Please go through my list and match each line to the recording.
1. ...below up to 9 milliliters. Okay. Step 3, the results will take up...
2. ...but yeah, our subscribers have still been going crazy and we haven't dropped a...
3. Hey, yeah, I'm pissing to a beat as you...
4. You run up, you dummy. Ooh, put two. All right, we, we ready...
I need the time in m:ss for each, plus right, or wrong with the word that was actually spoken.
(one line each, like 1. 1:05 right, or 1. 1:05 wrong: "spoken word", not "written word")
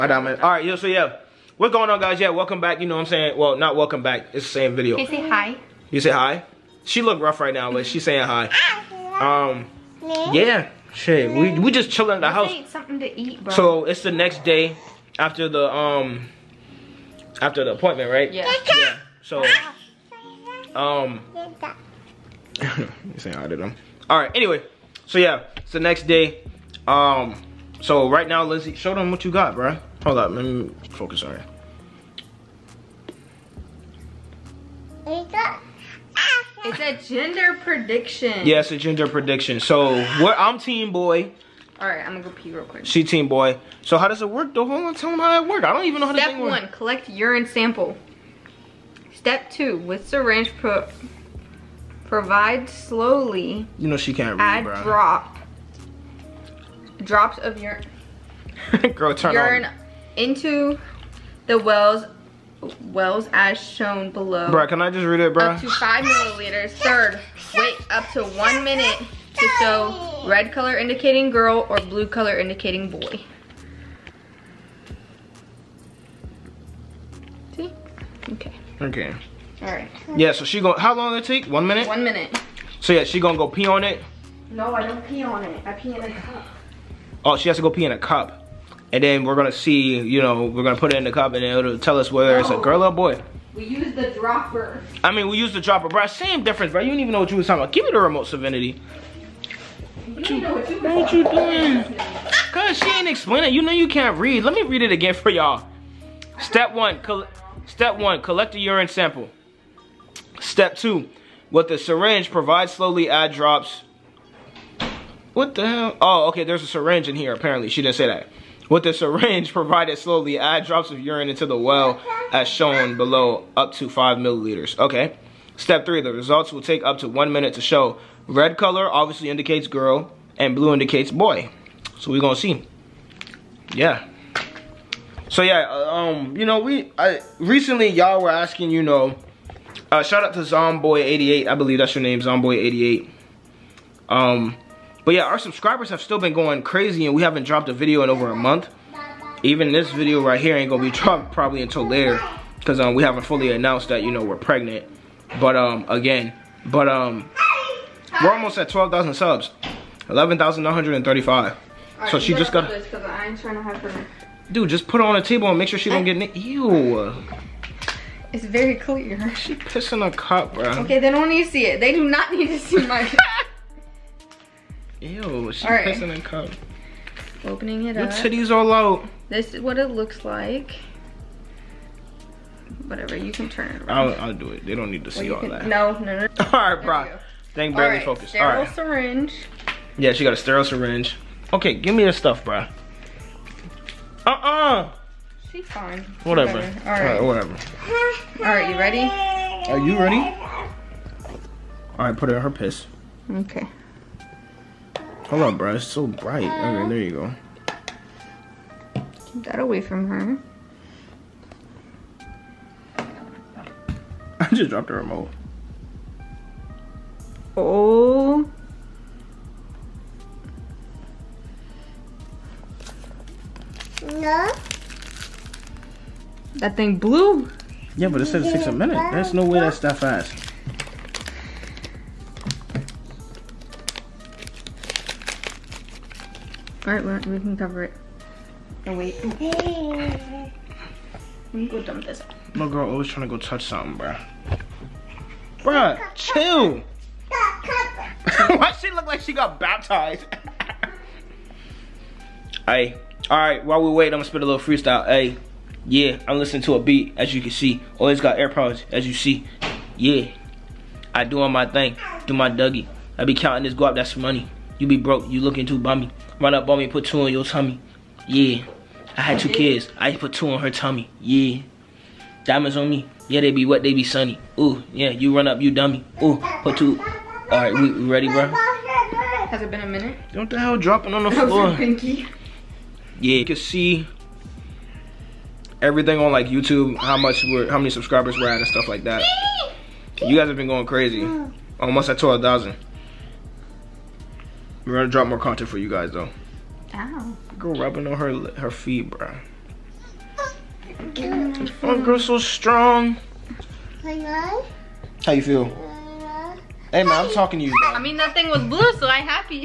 1. 2:02 wrong: "5", not "9"
2. 2:25 right
3. 4:15 wrong: "listening", not "pissing"
4. 4:35 right.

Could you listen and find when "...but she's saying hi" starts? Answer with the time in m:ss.
0:07.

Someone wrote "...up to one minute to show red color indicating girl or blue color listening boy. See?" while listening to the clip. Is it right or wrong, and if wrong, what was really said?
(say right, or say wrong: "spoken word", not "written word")
wrong: "indicating", not "listening".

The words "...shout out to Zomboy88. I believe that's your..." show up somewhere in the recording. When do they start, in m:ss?
2:20.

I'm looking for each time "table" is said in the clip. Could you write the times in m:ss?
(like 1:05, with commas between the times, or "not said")
2:45.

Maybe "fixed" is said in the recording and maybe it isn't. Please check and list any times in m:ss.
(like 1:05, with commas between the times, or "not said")
not said.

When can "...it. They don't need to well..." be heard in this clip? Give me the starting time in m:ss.
3:04.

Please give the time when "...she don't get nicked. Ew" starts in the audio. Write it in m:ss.
2:45.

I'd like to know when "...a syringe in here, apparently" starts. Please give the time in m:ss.
1:56.